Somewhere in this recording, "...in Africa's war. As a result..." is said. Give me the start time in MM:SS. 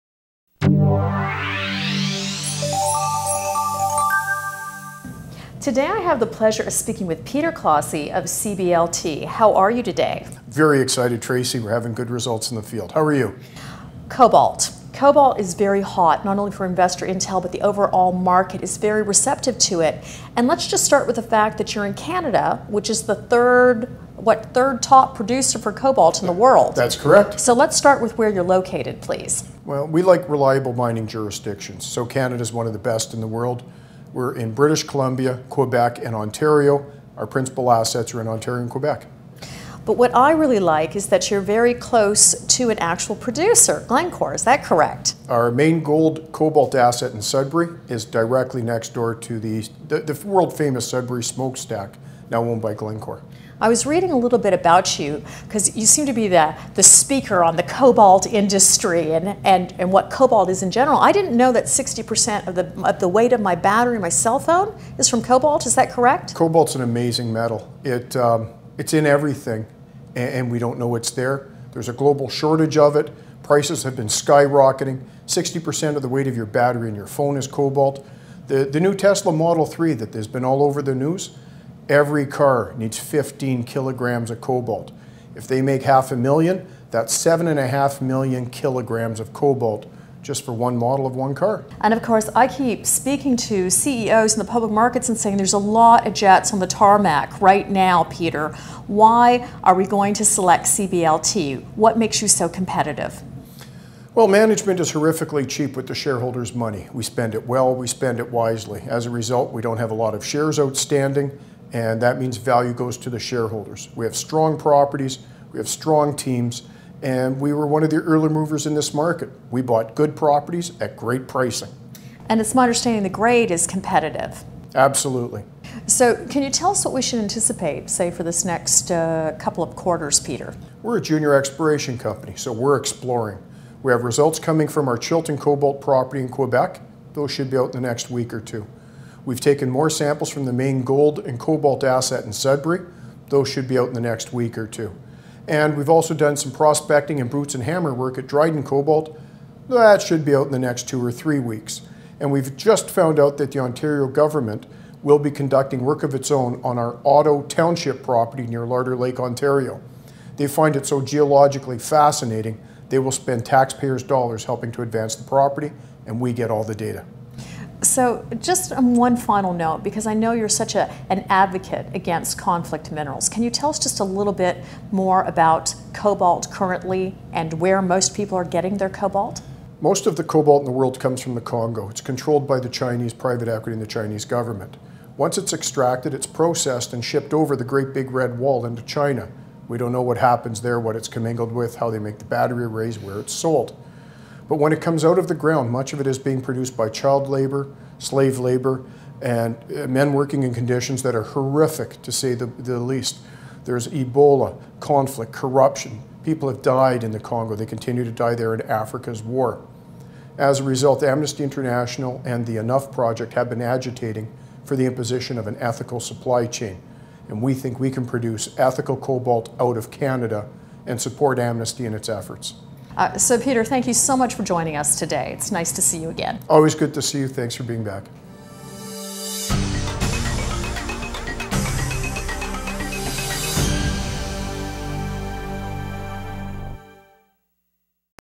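03:28.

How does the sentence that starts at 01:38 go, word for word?
Why are we going to select CBLT?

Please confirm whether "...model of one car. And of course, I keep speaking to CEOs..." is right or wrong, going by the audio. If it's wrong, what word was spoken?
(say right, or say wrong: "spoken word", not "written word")
right.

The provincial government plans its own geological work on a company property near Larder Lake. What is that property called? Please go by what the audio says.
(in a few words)
Otto Township.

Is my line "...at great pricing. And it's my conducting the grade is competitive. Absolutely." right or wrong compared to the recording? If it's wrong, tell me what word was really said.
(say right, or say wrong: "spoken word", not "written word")
wrong: "understanding", not "conducting".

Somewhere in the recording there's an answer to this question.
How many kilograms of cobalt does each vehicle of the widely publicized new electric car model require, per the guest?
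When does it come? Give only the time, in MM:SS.
01:22.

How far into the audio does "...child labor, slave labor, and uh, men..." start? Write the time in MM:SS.
03:16.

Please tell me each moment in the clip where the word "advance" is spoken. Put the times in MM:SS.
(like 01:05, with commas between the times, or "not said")
02:44.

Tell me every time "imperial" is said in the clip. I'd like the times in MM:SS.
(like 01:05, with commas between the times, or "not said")
not said.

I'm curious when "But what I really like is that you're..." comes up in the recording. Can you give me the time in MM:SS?
00:39.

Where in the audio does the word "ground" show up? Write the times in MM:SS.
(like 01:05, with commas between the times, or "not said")
03:15.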